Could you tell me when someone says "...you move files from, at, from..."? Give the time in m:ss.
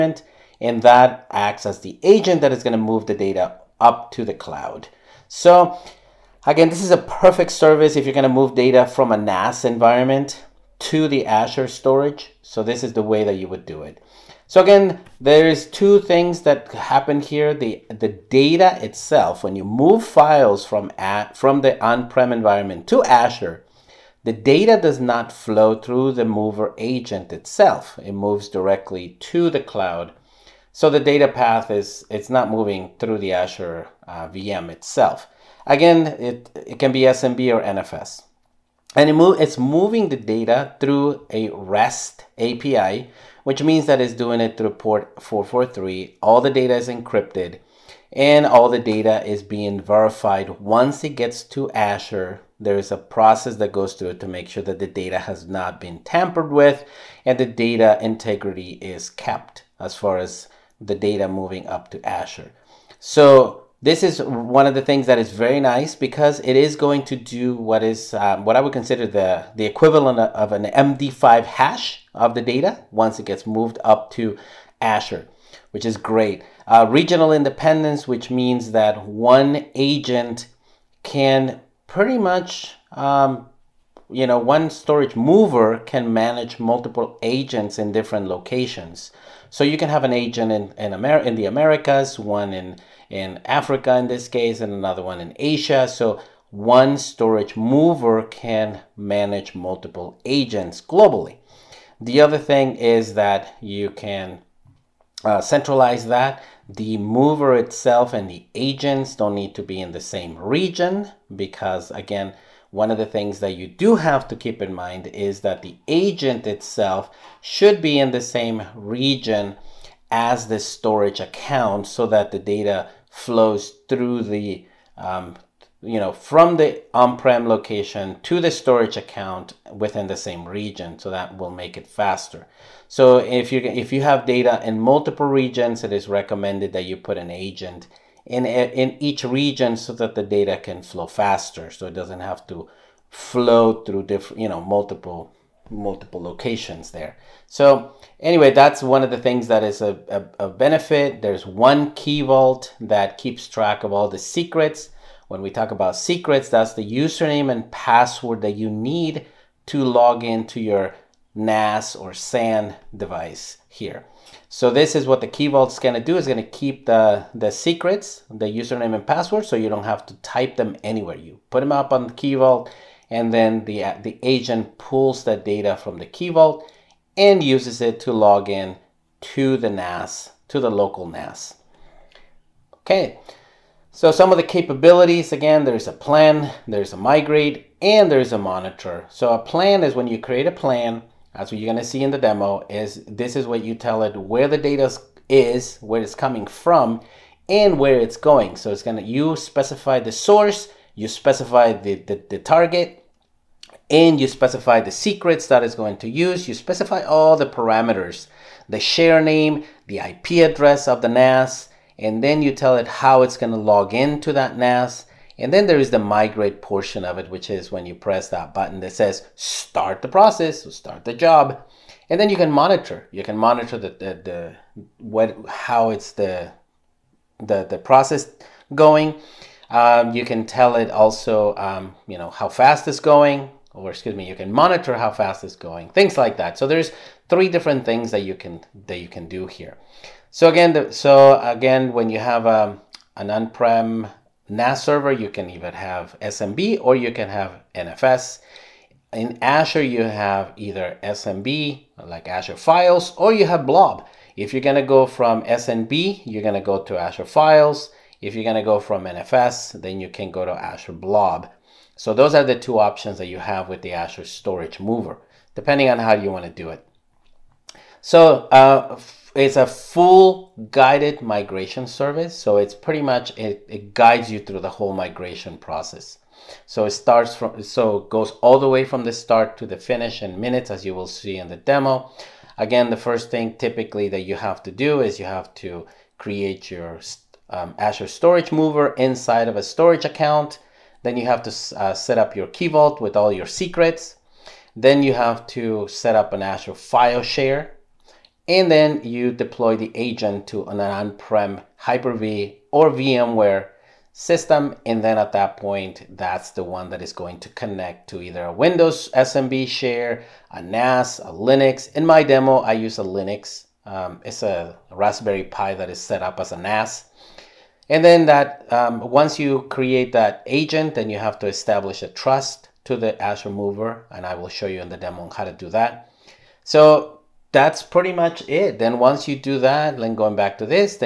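0:19.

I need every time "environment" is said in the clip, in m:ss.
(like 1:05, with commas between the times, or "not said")
0:09, 0:22.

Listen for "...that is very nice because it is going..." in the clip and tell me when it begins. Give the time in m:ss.
1:05.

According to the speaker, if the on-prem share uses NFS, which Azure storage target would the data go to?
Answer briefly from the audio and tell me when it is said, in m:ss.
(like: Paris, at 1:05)
Azure Blob, at 4:20.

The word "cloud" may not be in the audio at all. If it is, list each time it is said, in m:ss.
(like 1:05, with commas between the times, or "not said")
0:04, 0:29.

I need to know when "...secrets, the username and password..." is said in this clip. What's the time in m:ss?
2:47.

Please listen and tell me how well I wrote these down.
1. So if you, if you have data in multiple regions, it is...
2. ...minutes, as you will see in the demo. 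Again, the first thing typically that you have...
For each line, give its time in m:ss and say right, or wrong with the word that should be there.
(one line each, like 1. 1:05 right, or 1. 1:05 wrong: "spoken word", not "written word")
1. 2:12 right
2. 4:40 right.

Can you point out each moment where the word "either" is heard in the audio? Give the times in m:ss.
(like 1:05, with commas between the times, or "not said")
4:10, 5:08.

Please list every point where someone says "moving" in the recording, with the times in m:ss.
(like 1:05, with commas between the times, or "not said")
0:32, 0:39, 1:01.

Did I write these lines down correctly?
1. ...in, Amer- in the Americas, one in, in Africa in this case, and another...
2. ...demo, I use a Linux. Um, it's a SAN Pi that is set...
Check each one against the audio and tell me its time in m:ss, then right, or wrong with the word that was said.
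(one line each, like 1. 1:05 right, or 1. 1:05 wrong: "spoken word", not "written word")
1. 1:30 right
2. 5:12 wrong: "Raspberry", not "SAN".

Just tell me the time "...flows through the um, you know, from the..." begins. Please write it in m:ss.
2:03.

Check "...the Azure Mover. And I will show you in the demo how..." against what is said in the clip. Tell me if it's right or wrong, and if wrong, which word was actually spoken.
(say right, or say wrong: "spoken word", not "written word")
right.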